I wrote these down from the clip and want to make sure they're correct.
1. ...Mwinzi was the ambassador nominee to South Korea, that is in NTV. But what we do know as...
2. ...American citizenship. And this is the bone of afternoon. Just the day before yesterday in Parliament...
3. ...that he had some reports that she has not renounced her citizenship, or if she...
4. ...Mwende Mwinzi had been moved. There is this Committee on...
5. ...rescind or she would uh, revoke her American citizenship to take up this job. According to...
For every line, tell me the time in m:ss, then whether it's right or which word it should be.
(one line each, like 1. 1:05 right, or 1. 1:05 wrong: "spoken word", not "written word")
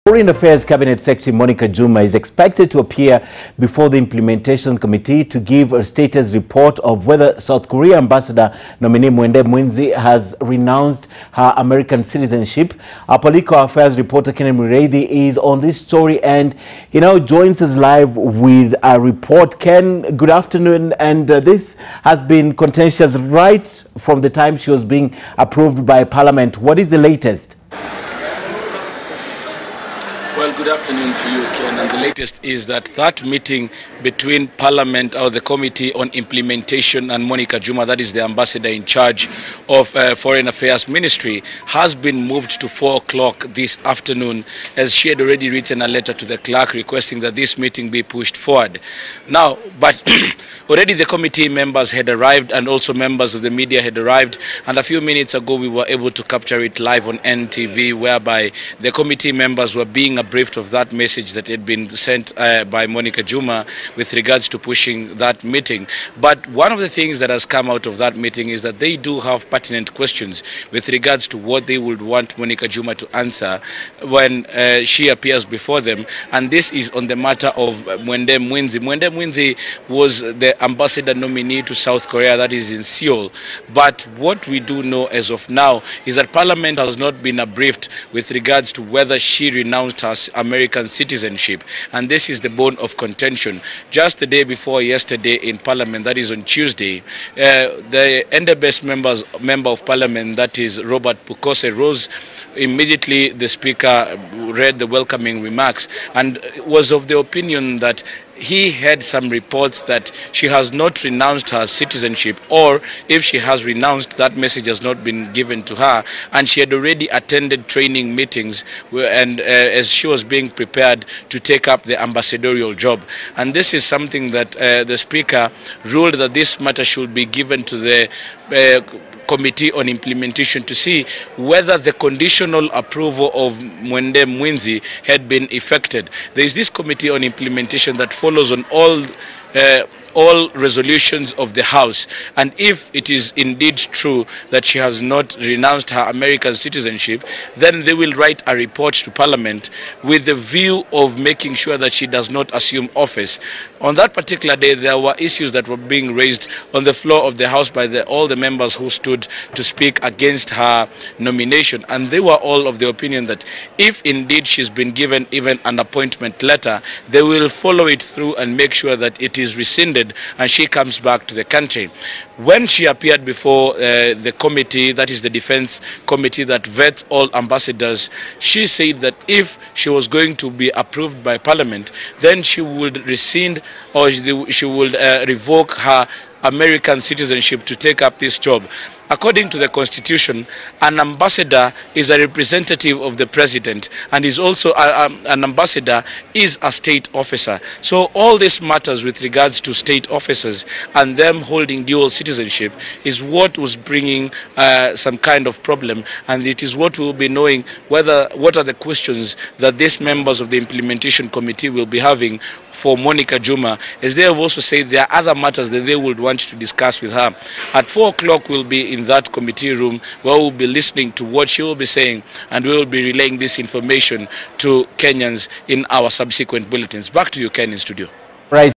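1. 1:19 wrong: "Seoul", not "NTV"
2. 1:30 wrong: "contention", not "afternoon"
3. 1:47 right
4. 2:13 wrong: "effected", not "moved"
5. 3:03 right.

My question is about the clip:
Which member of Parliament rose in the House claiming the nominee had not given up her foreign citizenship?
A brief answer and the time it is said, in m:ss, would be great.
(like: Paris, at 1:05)
Robert Pukose, at 1:40.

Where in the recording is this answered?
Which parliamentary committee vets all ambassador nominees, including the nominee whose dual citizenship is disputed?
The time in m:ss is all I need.
2:55.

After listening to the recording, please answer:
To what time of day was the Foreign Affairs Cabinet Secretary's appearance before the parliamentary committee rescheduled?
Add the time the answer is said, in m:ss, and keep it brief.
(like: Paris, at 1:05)
4 o'clock, at 0:42.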